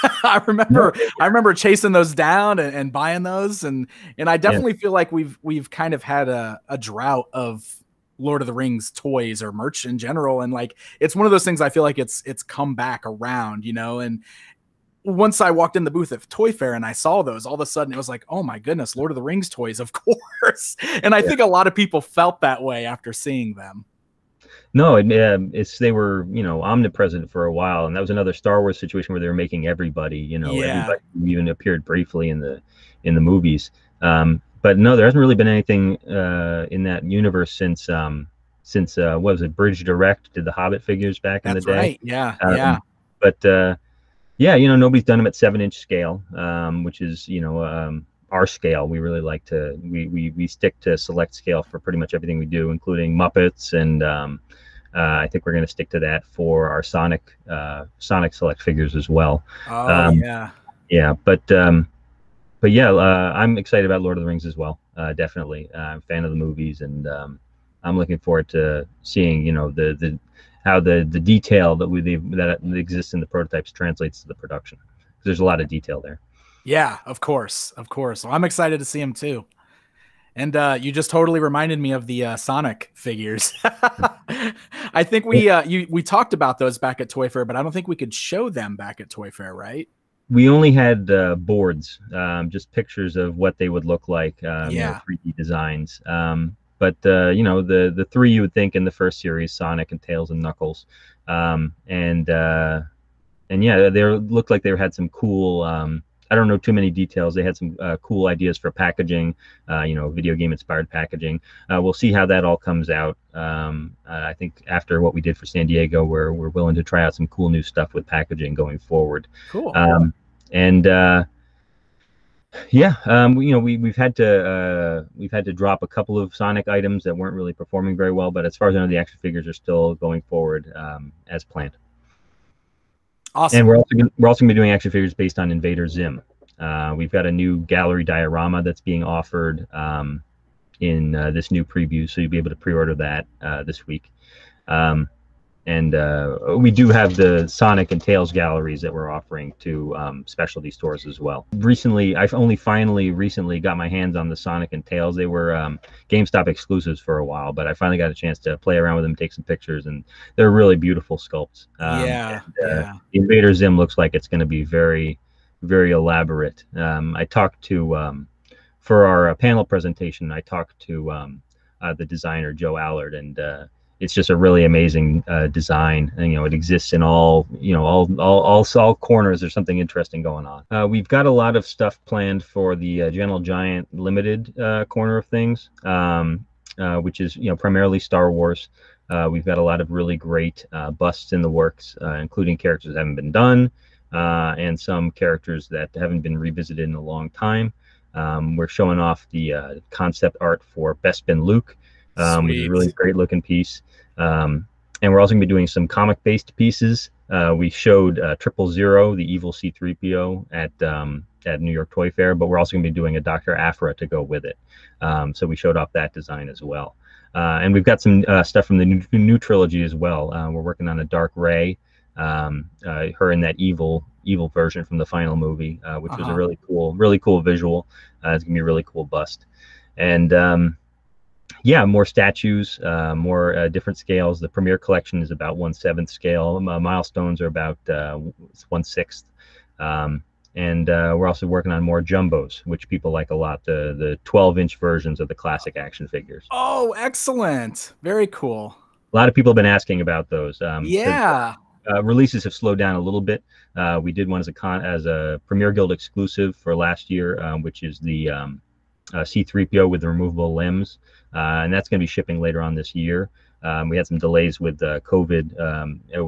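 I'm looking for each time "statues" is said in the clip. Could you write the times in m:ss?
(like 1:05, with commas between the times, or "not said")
3:52.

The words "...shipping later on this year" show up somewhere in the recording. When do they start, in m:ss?
4:22.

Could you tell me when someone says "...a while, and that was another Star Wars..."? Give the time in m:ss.
0:27.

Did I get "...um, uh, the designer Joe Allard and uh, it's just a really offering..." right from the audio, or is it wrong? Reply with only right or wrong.
wrong.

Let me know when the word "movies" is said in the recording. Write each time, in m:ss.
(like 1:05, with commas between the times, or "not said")
0:33, 1:06, 3:45.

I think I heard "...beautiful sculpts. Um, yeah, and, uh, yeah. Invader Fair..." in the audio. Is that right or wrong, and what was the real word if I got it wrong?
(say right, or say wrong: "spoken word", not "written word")
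wrong: "Zim", not "Fair".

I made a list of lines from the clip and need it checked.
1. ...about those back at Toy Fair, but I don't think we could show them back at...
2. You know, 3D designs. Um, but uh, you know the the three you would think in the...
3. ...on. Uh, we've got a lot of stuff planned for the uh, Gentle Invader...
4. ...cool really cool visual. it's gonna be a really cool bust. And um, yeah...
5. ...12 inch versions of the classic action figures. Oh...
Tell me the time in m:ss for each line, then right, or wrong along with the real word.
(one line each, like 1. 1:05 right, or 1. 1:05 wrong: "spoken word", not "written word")
1. 1:26 right
2. 1:35 right
3. 3:00 wrong: "Giant", not "Invader"
4. 3:46 right
5. 4:04 right.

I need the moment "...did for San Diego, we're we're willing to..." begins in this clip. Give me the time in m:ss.
1:55.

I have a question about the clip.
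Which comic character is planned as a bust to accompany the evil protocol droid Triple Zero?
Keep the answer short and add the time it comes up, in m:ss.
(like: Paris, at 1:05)
Dr. Aphra, at 3:33.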